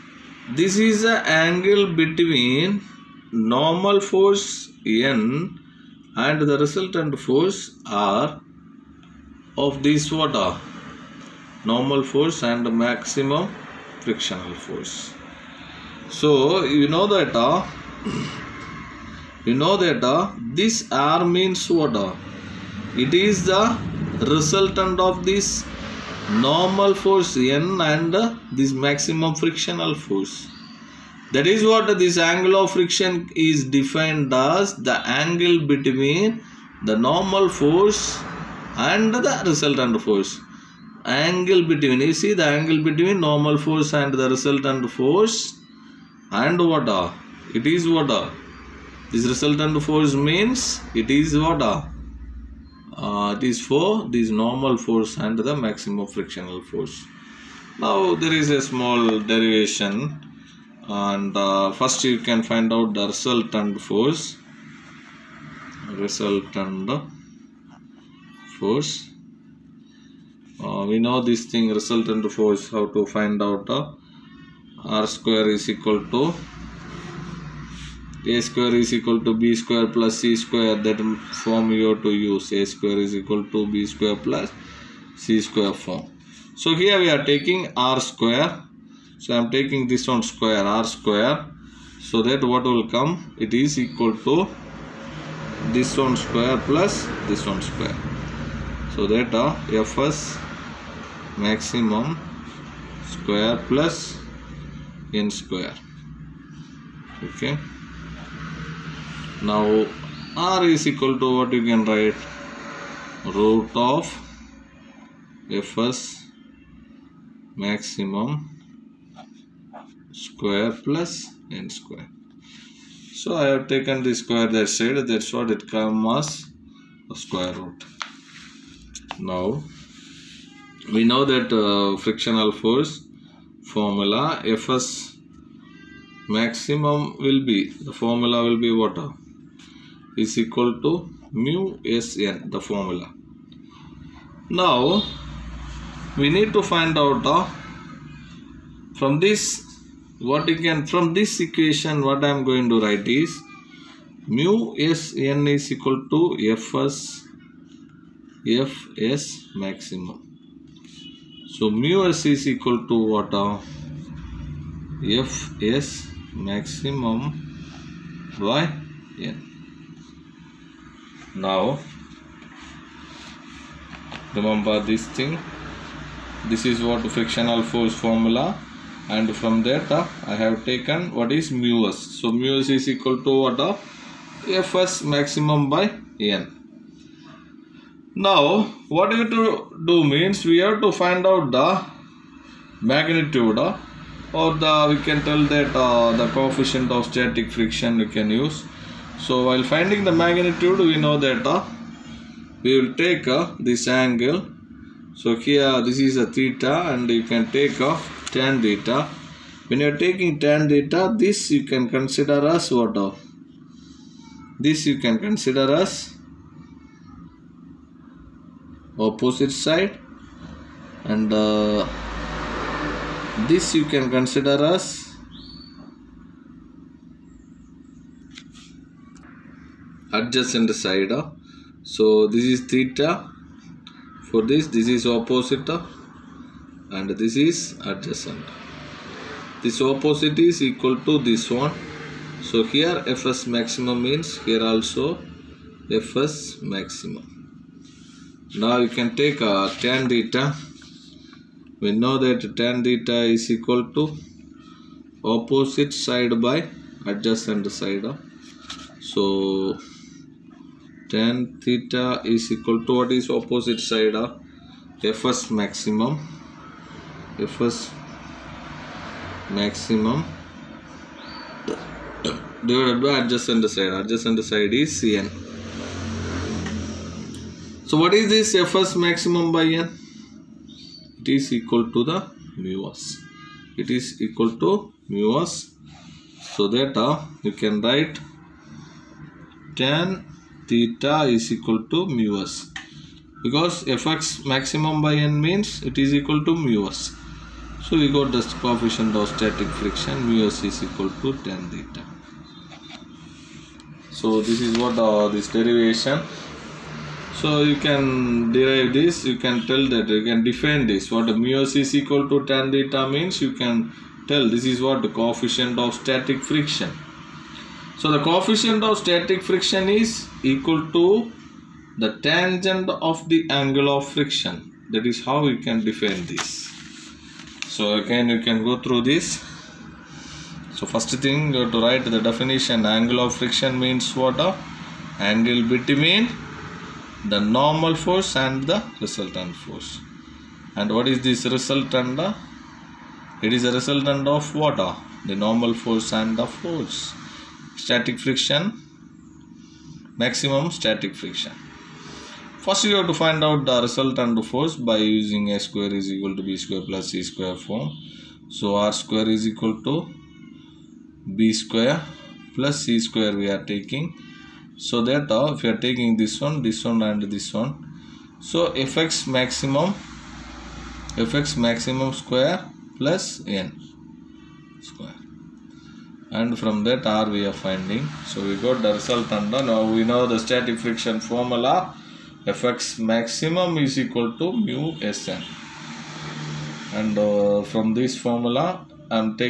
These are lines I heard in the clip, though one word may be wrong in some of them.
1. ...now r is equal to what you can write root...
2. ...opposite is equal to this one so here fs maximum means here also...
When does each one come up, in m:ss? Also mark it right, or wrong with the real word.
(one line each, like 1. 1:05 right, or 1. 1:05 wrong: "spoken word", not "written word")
1. 1:49 right
2. 3:59 right.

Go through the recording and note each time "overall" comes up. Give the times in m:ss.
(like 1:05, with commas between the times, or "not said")
not said.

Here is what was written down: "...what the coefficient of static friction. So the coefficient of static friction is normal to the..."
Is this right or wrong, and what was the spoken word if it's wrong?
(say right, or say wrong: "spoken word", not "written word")
wrong: "equal", not "normal".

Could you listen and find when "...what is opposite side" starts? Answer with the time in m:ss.
4:22.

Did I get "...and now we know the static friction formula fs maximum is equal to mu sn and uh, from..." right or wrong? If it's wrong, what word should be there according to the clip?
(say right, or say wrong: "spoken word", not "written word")
right.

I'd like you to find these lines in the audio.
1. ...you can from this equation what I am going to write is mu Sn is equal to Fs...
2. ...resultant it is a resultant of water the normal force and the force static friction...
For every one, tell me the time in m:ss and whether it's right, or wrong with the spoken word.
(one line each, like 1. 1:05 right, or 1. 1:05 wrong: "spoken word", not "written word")
1. 2:30 right
2. 5:41 right.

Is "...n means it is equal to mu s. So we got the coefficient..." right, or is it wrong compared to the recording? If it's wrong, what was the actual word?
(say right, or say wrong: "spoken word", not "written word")
right.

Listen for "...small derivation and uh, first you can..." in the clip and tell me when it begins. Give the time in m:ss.
0:58.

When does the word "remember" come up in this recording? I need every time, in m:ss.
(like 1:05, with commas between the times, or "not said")
2:54.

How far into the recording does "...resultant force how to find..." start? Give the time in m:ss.
1:11.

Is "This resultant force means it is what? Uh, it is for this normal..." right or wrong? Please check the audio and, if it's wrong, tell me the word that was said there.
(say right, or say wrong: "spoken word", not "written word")
right.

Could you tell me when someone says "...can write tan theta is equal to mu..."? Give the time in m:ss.
4:47.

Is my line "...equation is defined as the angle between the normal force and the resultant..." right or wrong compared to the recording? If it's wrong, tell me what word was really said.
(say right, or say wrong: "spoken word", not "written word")
wrong: "friction", not "equation".